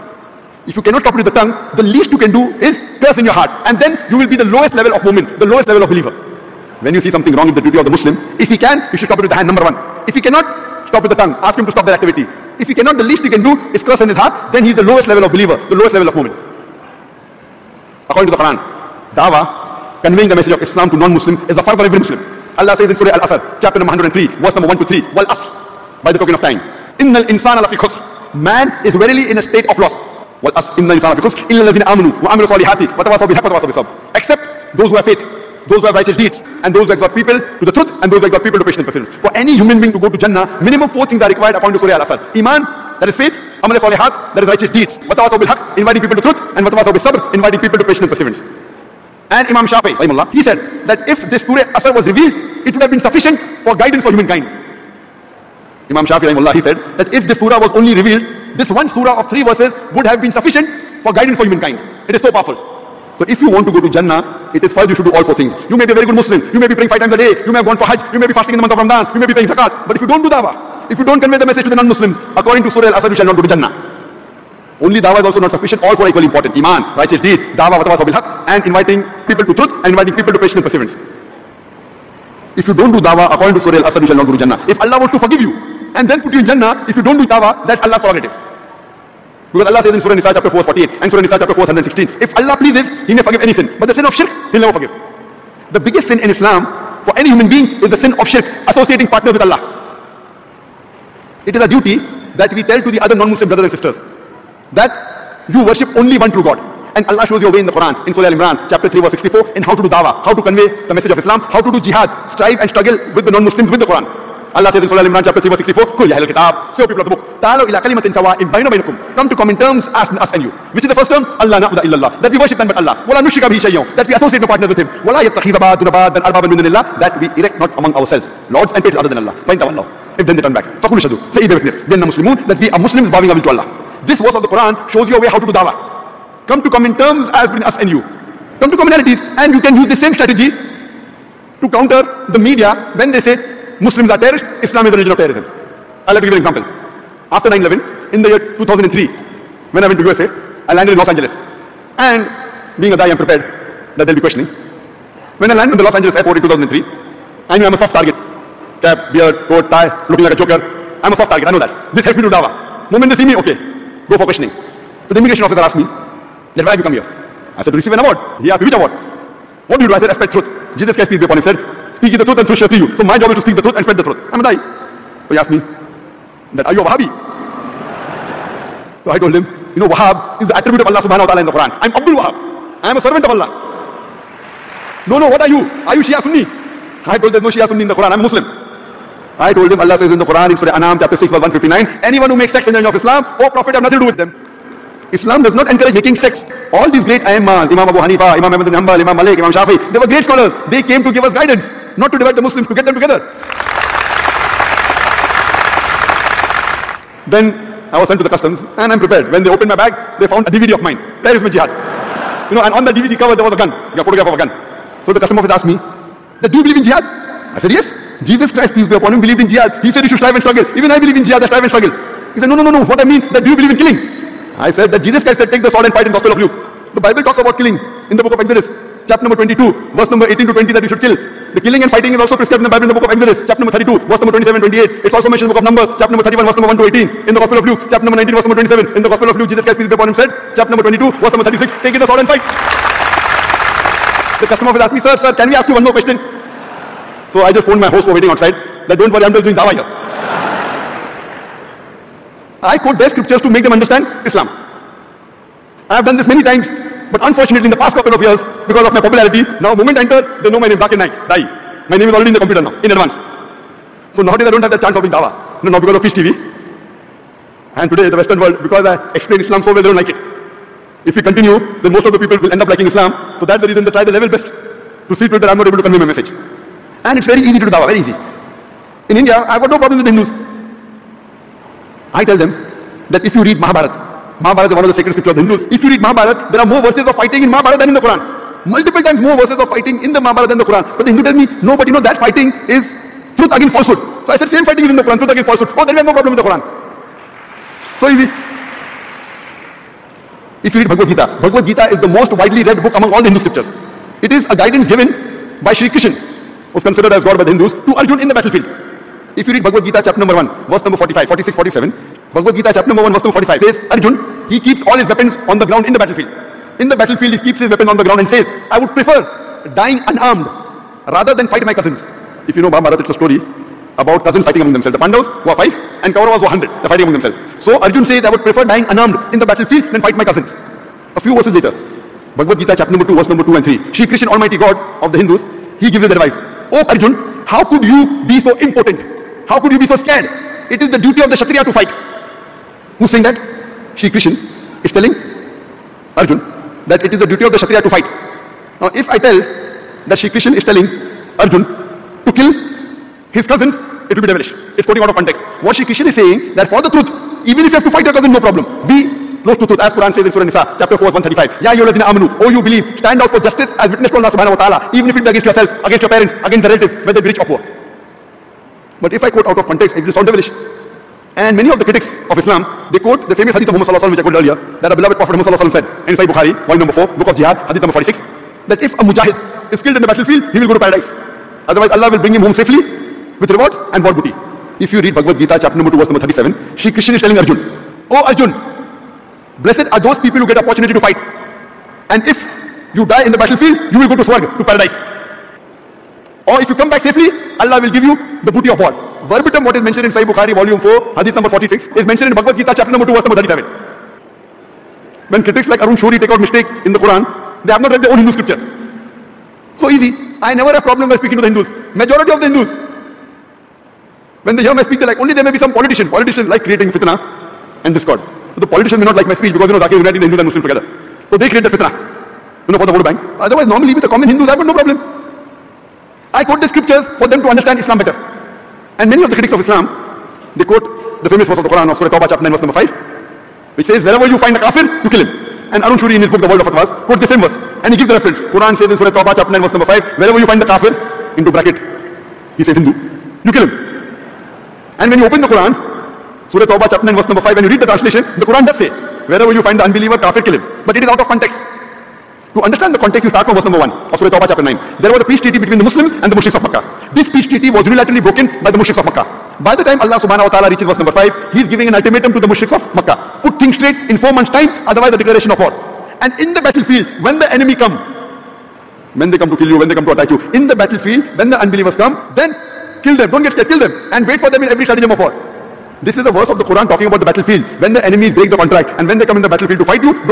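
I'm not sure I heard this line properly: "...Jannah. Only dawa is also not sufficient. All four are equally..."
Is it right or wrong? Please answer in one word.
right.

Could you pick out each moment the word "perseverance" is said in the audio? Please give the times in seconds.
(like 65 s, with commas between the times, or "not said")
38 s, 48 s, 80 s.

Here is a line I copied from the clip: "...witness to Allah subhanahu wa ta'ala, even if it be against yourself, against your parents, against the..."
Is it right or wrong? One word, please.
right.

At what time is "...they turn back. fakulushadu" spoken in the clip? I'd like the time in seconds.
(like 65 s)
130 s.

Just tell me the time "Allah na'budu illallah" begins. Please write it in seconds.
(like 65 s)
121 s.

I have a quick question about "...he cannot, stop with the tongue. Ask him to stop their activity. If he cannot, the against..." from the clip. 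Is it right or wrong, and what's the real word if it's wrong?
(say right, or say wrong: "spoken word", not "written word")
wrong: "least", not "against".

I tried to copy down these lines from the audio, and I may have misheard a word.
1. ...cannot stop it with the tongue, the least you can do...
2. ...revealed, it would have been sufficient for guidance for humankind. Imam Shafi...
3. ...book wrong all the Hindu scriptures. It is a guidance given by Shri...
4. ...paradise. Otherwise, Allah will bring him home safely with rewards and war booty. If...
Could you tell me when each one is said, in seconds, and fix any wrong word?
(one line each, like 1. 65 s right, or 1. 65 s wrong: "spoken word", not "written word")
1. 0 s right
2. 52 s right
3. 302 s wrong: "among", not "wrong"
4. 380 s right.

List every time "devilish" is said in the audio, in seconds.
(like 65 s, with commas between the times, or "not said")
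354 s, 370 s.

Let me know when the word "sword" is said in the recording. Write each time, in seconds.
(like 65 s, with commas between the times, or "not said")
225 s, 242 s.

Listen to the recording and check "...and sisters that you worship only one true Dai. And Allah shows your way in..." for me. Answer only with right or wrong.
wrong.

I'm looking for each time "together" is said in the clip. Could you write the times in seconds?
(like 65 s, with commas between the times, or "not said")
202 s, 420 s.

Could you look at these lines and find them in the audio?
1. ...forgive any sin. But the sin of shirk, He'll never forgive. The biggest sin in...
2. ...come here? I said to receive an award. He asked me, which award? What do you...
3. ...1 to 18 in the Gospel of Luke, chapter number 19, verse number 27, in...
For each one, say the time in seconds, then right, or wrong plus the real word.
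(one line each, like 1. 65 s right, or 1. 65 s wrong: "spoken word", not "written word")
1. 93 s right
2. 166 s right
3. 236 s right.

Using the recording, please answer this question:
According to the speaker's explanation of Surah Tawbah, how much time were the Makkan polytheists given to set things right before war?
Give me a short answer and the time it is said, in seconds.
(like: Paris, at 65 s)
4 months, at 464 s.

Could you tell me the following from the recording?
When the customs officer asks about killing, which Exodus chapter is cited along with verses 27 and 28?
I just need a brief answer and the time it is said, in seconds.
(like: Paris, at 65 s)
32, at 233 s.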